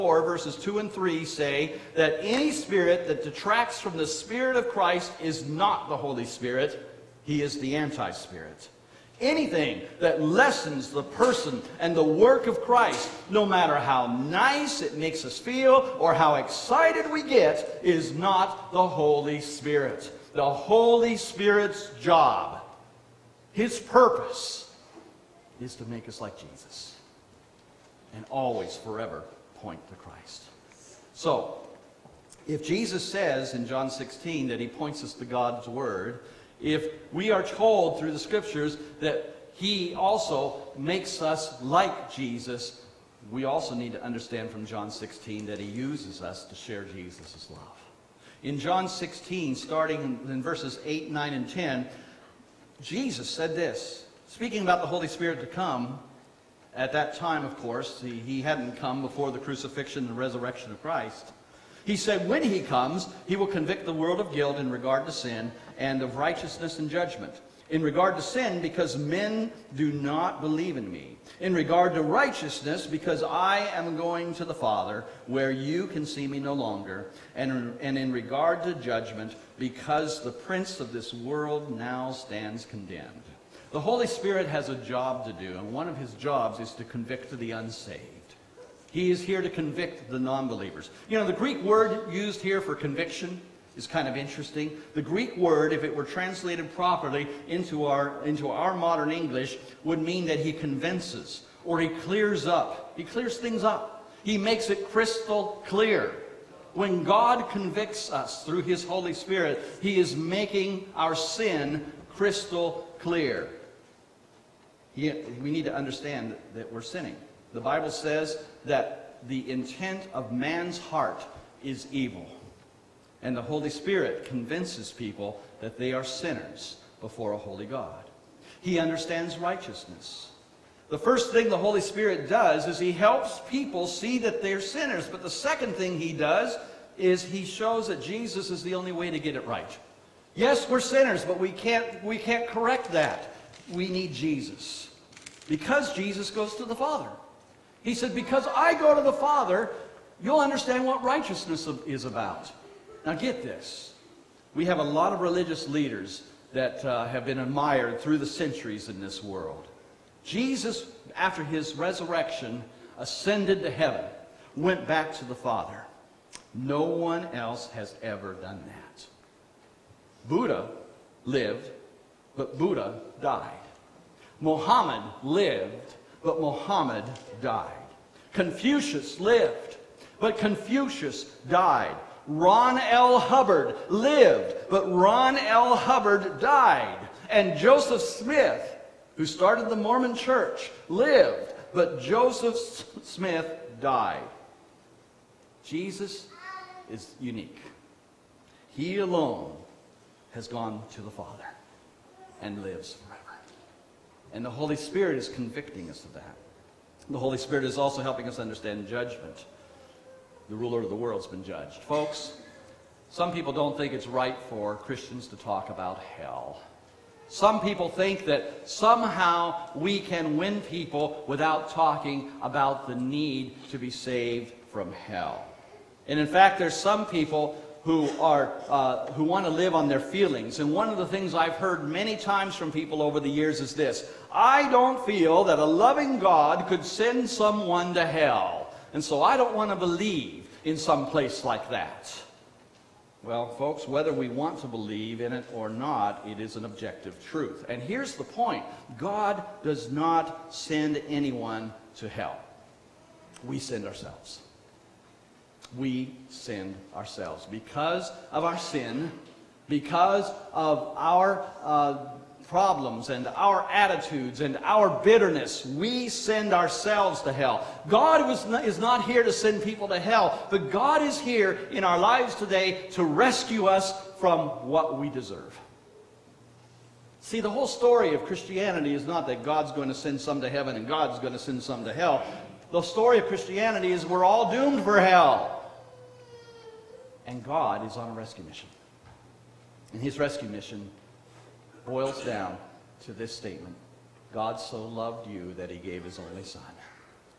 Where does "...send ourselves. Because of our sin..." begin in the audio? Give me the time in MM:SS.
04:16.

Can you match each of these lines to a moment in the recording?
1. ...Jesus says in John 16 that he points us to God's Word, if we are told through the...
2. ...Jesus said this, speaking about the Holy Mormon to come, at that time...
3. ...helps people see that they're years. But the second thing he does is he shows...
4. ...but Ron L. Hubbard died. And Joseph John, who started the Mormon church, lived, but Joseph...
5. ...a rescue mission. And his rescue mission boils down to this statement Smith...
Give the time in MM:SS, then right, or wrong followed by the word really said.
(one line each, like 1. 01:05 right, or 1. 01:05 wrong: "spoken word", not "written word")
1. 00:32 right
2. 00:52 wrong: "Spirit", not "Mormon"
3. 02:12 wrong: "sinners", not "years"
4. 03:04 wrong: "Smith", not "John"
5. 04:48 wrong: "God", not "Smith".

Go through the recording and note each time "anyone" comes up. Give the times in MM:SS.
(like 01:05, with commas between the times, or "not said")
04:11.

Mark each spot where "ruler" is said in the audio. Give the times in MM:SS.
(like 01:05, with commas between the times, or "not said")
03:30.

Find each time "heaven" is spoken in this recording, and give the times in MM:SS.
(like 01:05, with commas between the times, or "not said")
02:43, 04:40.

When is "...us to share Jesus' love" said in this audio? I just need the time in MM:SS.
00:46.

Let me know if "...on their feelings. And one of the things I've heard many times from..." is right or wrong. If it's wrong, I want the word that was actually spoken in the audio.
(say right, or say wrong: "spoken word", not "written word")
right.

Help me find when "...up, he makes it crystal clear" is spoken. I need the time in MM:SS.
01:43.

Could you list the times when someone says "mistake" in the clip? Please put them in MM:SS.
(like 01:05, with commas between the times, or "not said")
not said.